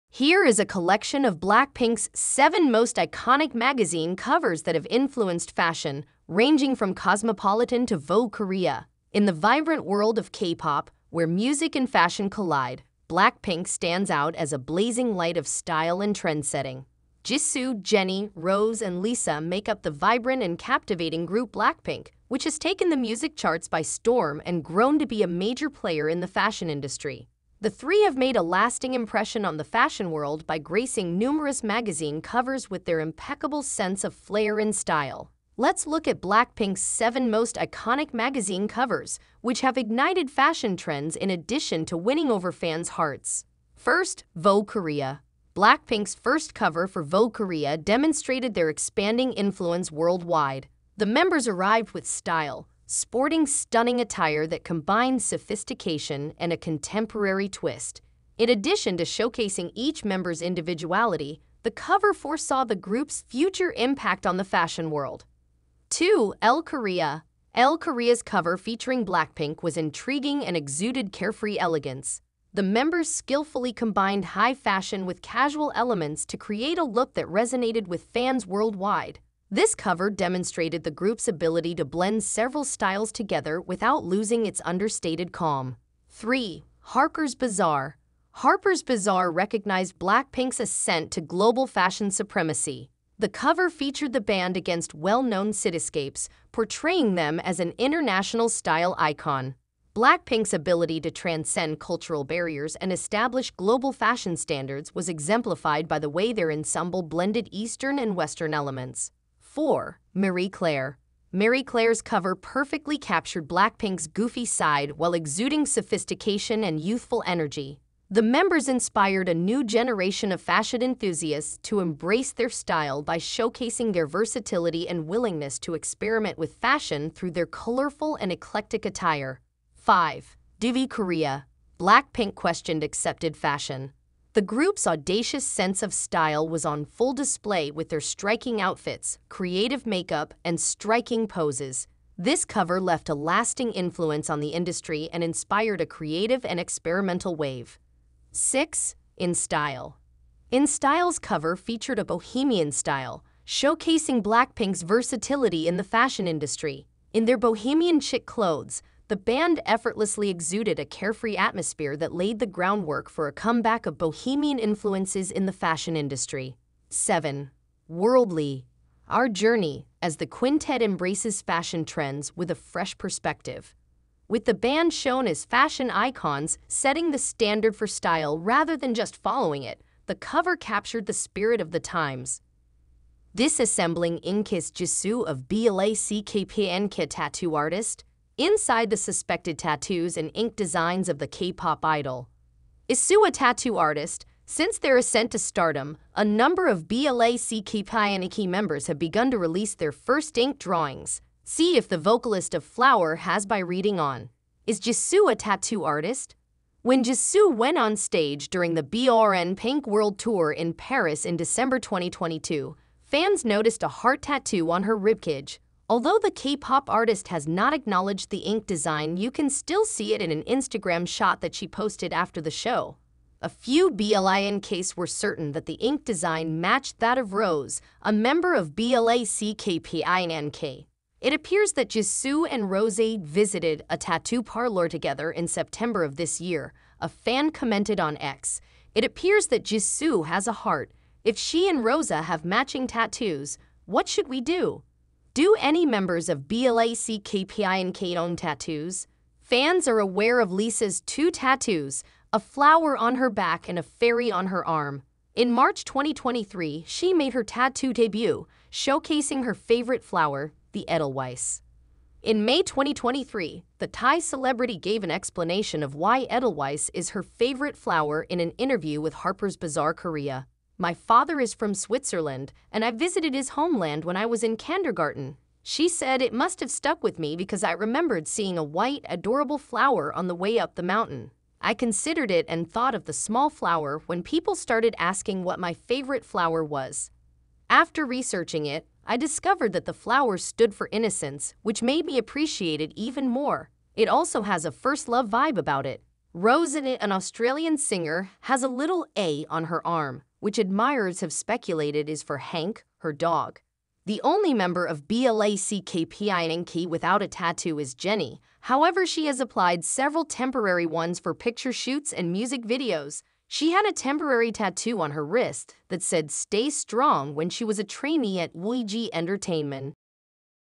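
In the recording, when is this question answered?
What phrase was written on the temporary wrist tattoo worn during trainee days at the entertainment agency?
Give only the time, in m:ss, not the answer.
5:16.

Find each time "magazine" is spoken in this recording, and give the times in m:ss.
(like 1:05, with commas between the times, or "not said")
0:03, 0:31, 0:38.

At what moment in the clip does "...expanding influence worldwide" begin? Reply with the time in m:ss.
0:48.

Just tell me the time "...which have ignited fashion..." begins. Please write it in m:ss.
0:39.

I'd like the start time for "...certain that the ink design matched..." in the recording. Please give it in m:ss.
3:45.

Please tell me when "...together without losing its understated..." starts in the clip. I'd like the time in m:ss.
1:23.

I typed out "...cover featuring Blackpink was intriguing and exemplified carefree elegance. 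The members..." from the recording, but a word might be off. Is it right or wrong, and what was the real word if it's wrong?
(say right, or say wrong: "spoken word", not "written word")
wrong: "exuded", not "exemplified".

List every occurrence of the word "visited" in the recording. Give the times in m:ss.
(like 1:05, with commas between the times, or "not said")
3:53, 4:32.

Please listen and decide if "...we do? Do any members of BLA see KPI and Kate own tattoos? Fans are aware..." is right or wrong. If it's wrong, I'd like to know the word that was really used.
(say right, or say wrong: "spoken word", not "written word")
right.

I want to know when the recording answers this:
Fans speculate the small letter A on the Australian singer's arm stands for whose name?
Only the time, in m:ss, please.
5:02.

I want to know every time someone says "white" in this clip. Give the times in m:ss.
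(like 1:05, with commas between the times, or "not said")
4:38.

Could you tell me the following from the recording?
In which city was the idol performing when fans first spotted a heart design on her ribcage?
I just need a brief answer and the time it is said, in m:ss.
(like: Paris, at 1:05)
Paris, at 3:30.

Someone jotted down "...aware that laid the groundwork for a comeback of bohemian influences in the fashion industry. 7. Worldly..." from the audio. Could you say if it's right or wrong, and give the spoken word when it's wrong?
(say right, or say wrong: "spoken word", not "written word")
wrong: "atmosphere", not "aware".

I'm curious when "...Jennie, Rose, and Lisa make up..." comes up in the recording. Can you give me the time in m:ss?
0:17.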